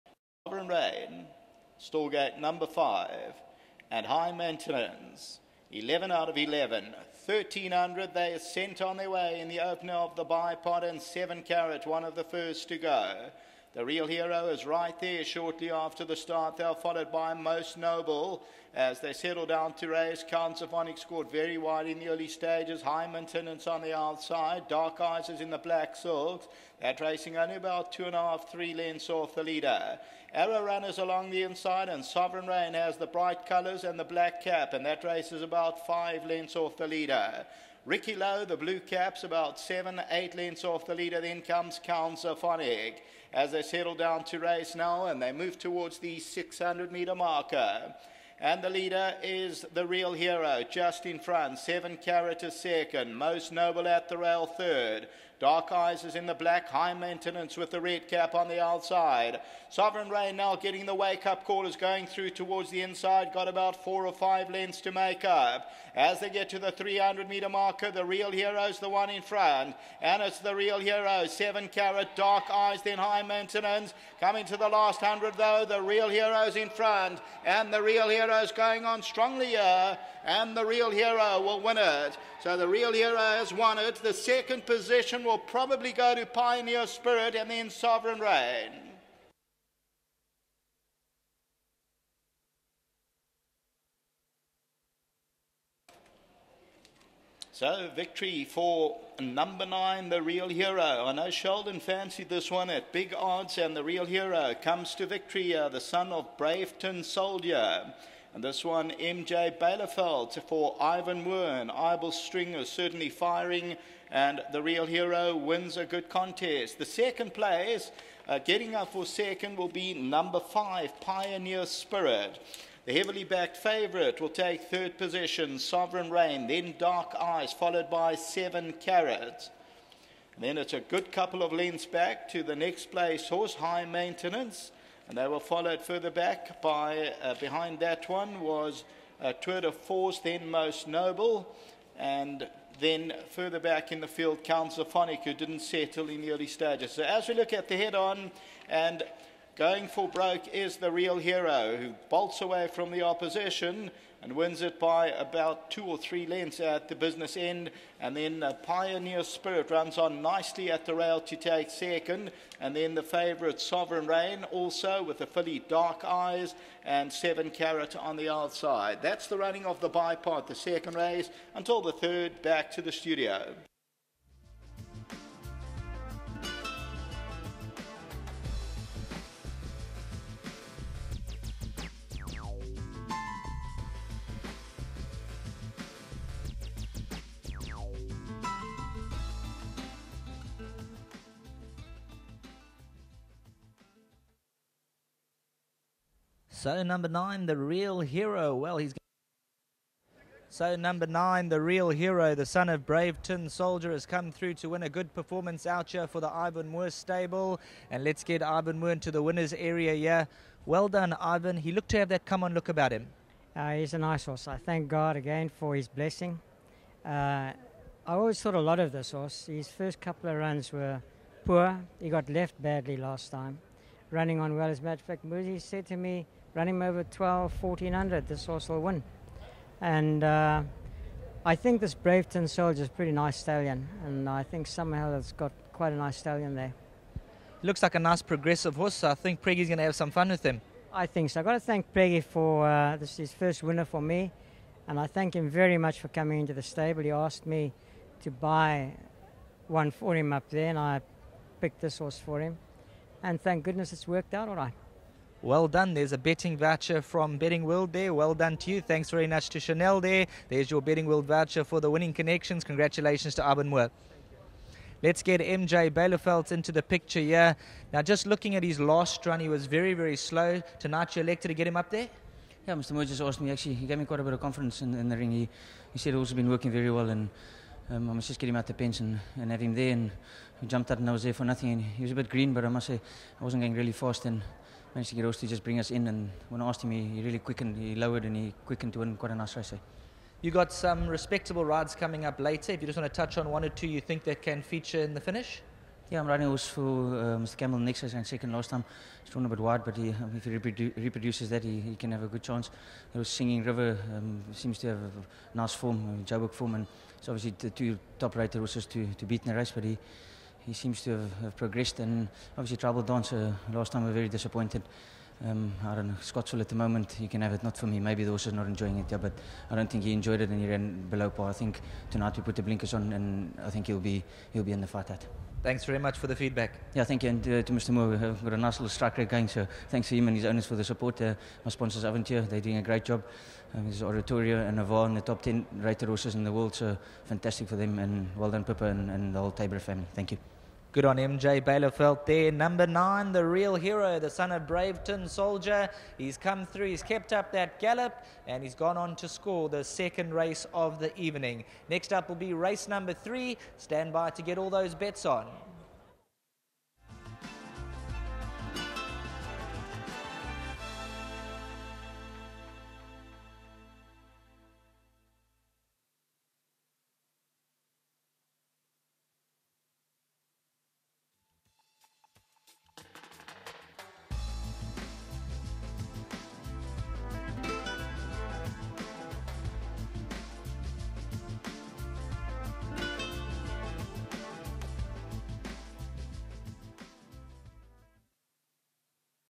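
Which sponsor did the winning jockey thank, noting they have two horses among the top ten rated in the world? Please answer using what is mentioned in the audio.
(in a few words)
Avontuur.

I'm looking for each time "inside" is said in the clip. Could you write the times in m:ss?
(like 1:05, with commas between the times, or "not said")
0:31, 1:02.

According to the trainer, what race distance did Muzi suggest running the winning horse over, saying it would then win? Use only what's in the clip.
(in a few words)
1400.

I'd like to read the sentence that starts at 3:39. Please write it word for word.
His first couple of runs were poor.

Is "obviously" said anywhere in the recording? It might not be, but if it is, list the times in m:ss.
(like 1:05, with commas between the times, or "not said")
5:07, 5:12.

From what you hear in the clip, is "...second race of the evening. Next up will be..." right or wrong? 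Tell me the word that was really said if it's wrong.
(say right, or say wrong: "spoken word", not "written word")
right.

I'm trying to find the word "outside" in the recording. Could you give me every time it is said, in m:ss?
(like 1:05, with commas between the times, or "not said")
0:23, 0:58, 2:48.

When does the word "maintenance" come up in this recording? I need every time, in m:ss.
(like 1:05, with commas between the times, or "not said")
0:04, 0:23, 0:56, 1:13, 2:13.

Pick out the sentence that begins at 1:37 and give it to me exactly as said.
So, victory for number nine, the real hero.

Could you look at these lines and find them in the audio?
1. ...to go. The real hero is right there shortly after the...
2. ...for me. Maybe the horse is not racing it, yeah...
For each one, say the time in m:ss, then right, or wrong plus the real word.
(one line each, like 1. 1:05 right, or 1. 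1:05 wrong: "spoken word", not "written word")
1. 0:12 right
2. 5:17 wrong: "enjoying", not "racing".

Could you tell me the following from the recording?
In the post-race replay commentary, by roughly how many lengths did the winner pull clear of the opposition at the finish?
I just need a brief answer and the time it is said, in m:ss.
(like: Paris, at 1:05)
2 or 3 lengths, at 2:35.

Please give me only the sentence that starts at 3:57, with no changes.
Looks like a nice progressive horse, so I think Preggy's going to have some fun with him.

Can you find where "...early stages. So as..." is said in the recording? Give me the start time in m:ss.
2:26.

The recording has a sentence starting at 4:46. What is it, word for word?
And when I asked him, he, he really quickened, he lowered and he quickened to win quite a nice race.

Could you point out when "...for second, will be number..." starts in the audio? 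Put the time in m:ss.
1:58.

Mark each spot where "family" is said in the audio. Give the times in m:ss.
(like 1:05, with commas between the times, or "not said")
5:39.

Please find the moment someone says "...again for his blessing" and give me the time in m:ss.
3:35.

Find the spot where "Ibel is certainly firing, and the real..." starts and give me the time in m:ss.
1:51.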